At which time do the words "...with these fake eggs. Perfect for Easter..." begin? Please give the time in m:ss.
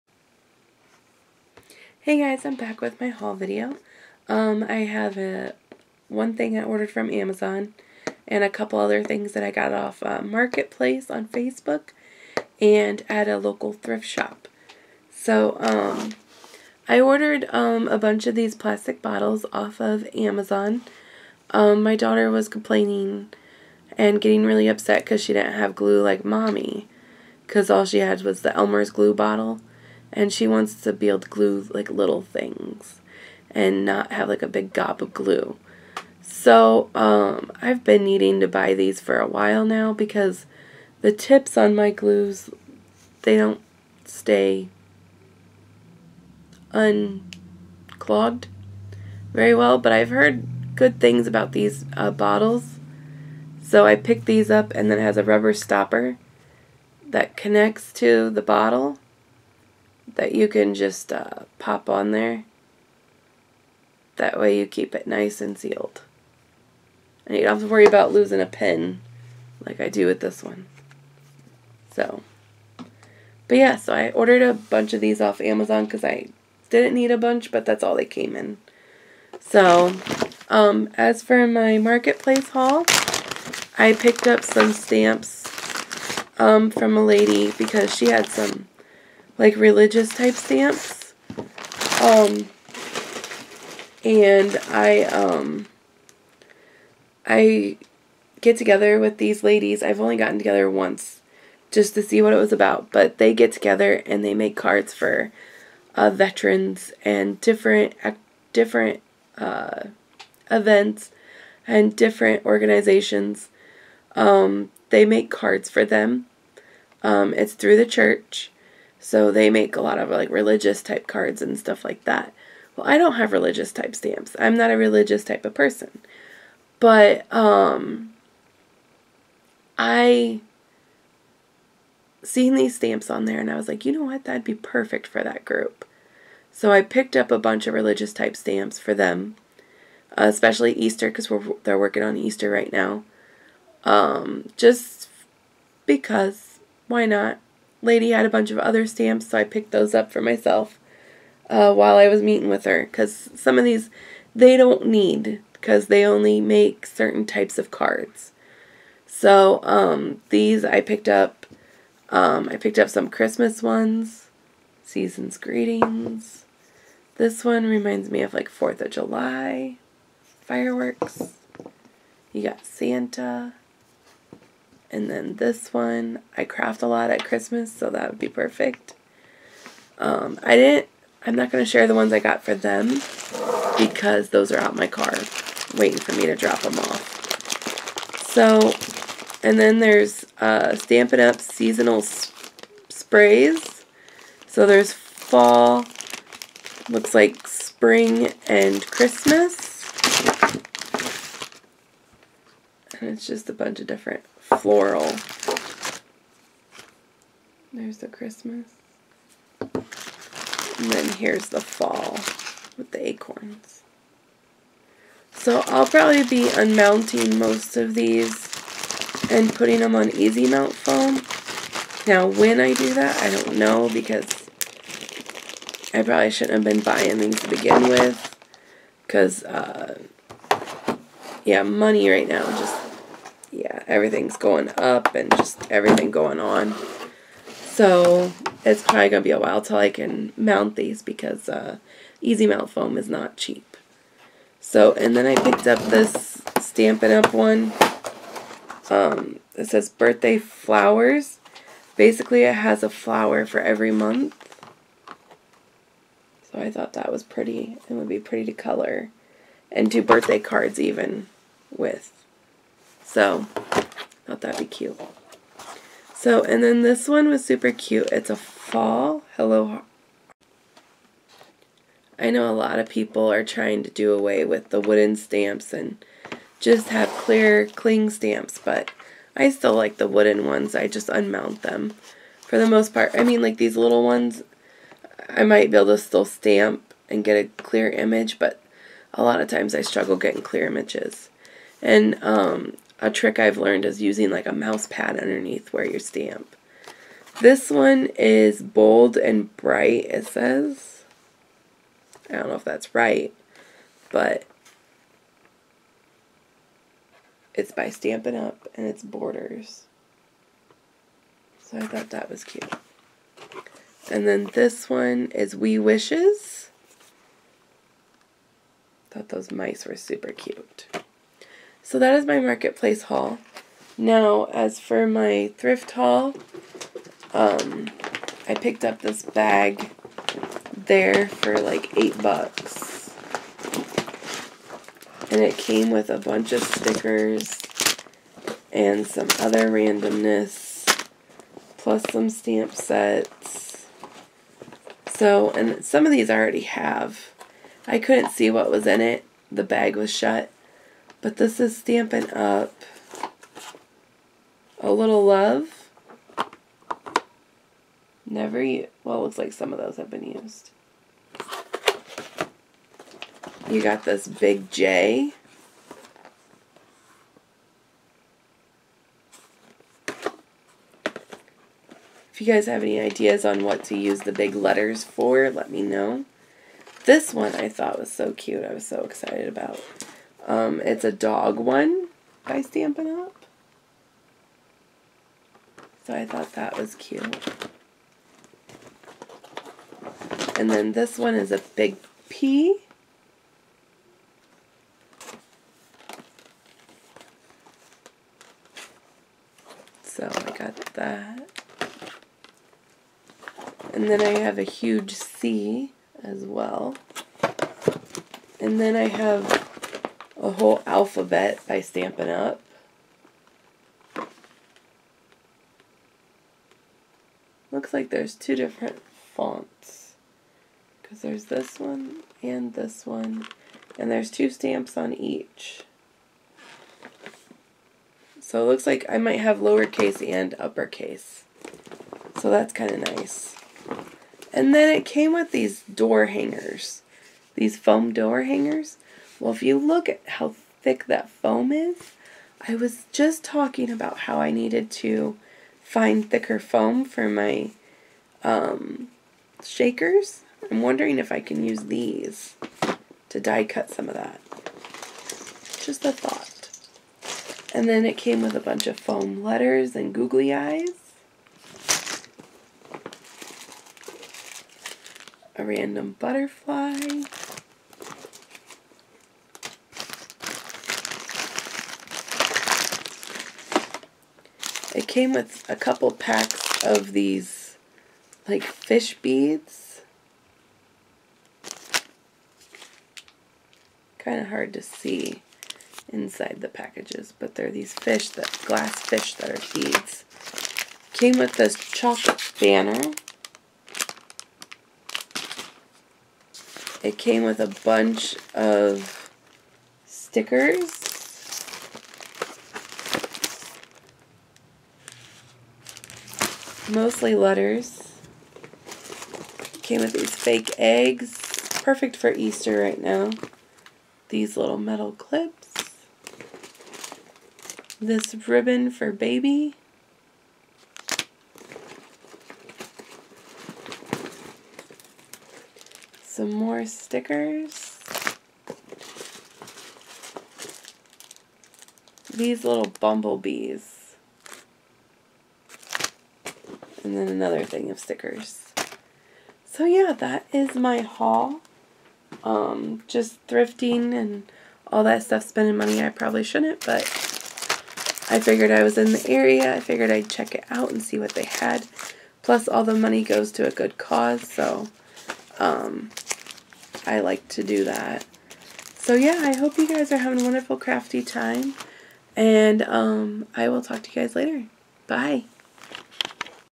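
8:30.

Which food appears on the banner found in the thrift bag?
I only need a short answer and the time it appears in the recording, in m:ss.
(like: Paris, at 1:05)
chocolate, at 8:11.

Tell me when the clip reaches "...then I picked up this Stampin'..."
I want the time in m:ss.
4:05.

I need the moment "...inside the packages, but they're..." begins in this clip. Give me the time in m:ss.
8:06.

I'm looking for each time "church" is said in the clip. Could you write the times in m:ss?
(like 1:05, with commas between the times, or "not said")
1:57.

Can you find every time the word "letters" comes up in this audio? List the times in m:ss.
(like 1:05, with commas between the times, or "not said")
6:14, 7:39, 8:27.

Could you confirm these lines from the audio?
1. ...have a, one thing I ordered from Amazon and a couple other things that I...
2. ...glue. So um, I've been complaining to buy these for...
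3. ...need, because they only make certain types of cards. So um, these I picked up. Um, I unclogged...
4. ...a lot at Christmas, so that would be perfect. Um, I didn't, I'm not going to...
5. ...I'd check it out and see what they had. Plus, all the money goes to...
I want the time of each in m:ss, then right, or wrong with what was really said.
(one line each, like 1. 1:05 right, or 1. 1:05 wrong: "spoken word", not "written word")
1. 0:04 right
2. 0:35 wrong: "needing", not "complaining"
3. 2:34 wrong: "picked", not "unclogged"
4. 2:56 right
5. 9:10 right.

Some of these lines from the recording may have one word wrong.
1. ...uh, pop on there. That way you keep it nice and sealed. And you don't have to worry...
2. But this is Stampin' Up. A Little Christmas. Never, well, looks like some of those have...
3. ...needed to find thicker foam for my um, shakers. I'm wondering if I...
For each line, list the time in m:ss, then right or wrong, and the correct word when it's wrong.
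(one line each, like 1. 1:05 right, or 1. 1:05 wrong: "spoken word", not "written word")
1. 1:01 right
2. 5:51 wrong: "Love", not "Christmas"
3. 7:24 right.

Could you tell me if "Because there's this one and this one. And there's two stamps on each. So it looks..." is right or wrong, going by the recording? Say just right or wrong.
right.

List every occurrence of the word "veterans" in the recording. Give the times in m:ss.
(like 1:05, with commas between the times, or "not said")
1:46.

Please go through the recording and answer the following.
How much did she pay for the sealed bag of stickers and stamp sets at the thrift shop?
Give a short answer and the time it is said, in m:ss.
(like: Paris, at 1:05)
$8, at 5:31.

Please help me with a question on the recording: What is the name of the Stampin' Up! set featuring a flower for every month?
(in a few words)
Birthday Flowers.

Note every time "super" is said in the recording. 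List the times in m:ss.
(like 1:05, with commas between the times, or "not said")
4:27, 5:19.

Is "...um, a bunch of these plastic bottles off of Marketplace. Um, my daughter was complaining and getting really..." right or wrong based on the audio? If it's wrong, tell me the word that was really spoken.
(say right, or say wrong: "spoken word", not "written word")
wrong: "Amazon", not "Marketplace".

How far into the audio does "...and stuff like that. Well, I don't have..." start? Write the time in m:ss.
2:01.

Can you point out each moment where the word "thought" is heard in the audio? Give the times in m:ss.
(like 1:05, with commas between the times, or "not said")
4:16, 4:24, 5:11, 5:19, 6:17, 6:26, 7:36.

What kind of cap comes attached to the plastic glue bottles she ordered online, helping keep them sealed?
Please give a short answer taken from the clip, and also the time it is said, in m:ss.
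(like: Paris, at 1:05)
rubber stopper, at 0:55.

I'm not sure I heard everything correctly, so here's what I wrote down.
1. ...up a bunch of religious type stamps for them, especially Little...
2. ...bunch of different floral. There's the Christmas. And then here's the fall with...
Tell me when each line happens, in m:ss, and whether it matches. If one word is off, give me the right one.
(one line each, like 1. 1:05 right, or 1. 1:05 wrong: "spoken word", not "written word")
1. 2:17 wrong: "Easter", not "Little"
2. 3:23 right.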